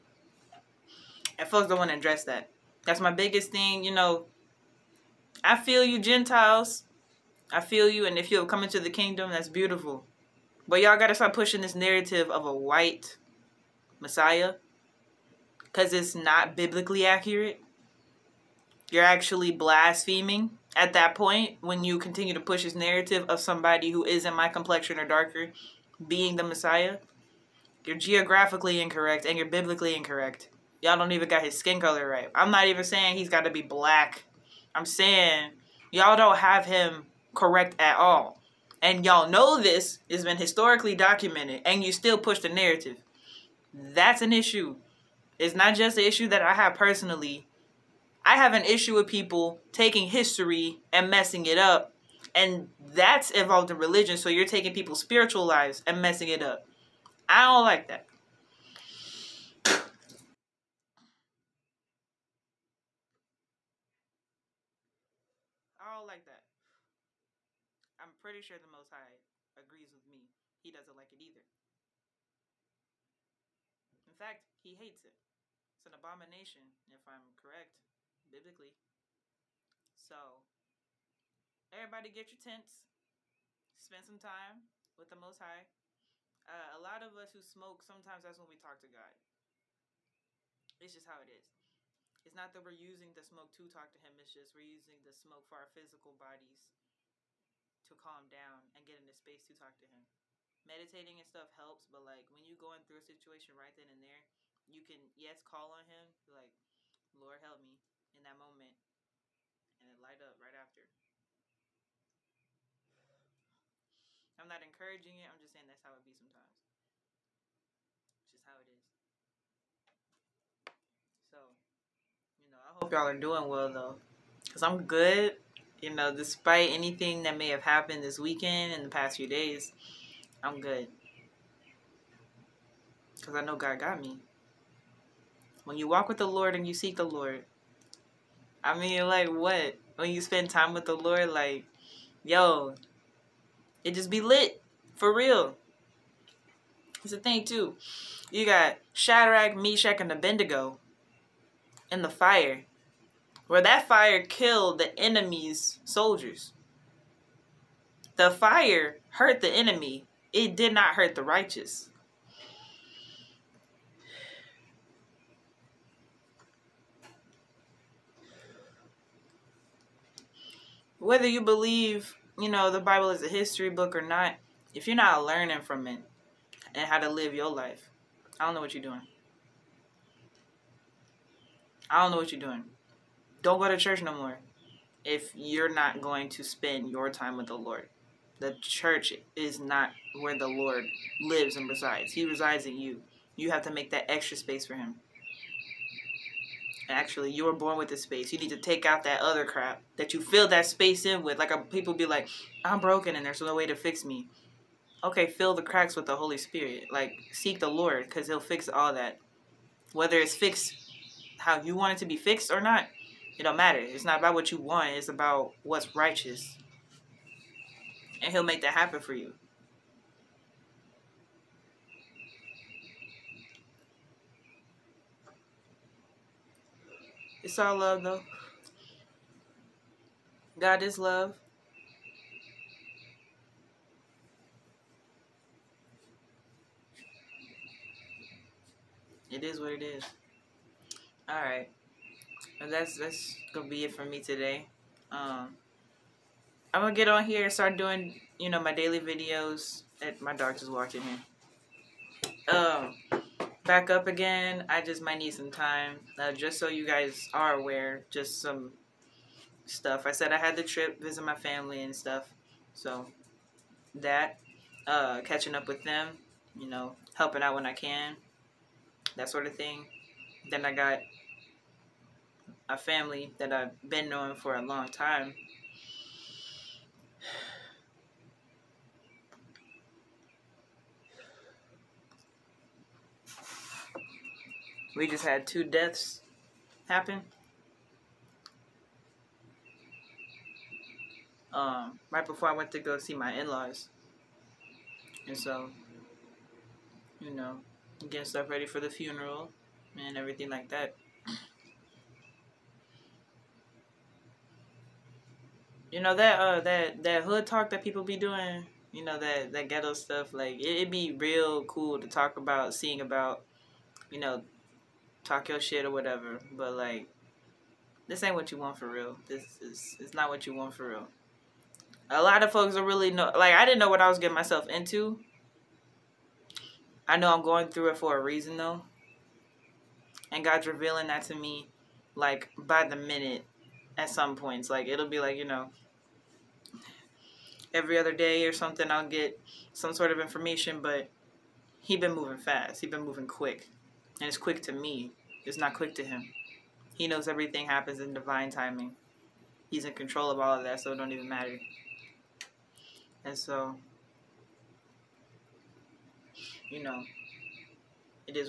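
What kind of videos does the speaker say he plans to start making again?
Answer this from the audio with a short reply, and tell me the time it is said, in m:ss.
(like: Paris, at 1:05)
Daily videos, at 4:08.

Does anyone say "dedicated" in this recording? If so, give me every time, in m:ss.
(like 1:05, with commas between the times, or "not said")
not said.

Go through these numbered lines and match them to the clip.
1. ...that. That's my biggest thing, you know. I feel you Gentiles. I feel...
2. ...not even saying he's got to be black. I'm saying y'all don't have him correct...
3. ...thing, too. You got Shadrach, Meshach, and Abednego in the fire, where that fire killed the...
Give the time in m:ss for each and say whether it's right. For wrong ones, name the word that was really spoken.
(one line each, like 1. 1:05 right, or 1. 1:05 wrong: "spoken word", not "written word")
1. 0:02 right
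2. 0:32 right
3. 2:27 right.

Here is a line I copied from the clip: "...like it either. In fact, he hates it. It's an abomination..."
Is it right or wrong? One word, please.
right.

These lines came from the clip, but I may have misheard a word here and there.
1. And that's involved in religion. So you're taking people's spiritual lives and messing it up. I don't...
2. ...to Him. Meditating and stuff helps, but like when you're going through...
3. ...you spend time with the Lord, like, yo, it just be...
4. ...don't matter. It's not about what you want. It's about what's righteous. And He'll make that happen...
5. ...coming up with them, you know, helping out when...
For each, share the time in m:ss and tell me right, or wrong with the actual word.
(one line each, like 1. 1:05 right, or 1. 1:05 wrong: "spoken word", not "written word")
1. 0:52 right
2. 1:39 right
3. 2:20 right
4. 3:33 right
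5. 4:25 wrong: "catching", not "coming".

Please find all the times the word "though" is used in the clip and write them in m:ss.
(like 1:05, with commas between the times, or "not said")
2:03, 3:48, 5:28.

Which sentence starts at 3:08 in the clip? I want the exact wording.
The church is not where the Lord lives and resides.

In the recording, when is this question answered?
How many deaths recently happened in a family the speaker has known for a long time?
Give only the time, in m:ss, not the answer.
4:45.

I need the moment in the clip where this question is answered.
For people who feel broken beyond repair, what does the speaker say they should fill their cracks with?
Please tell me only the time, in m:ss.
3:26.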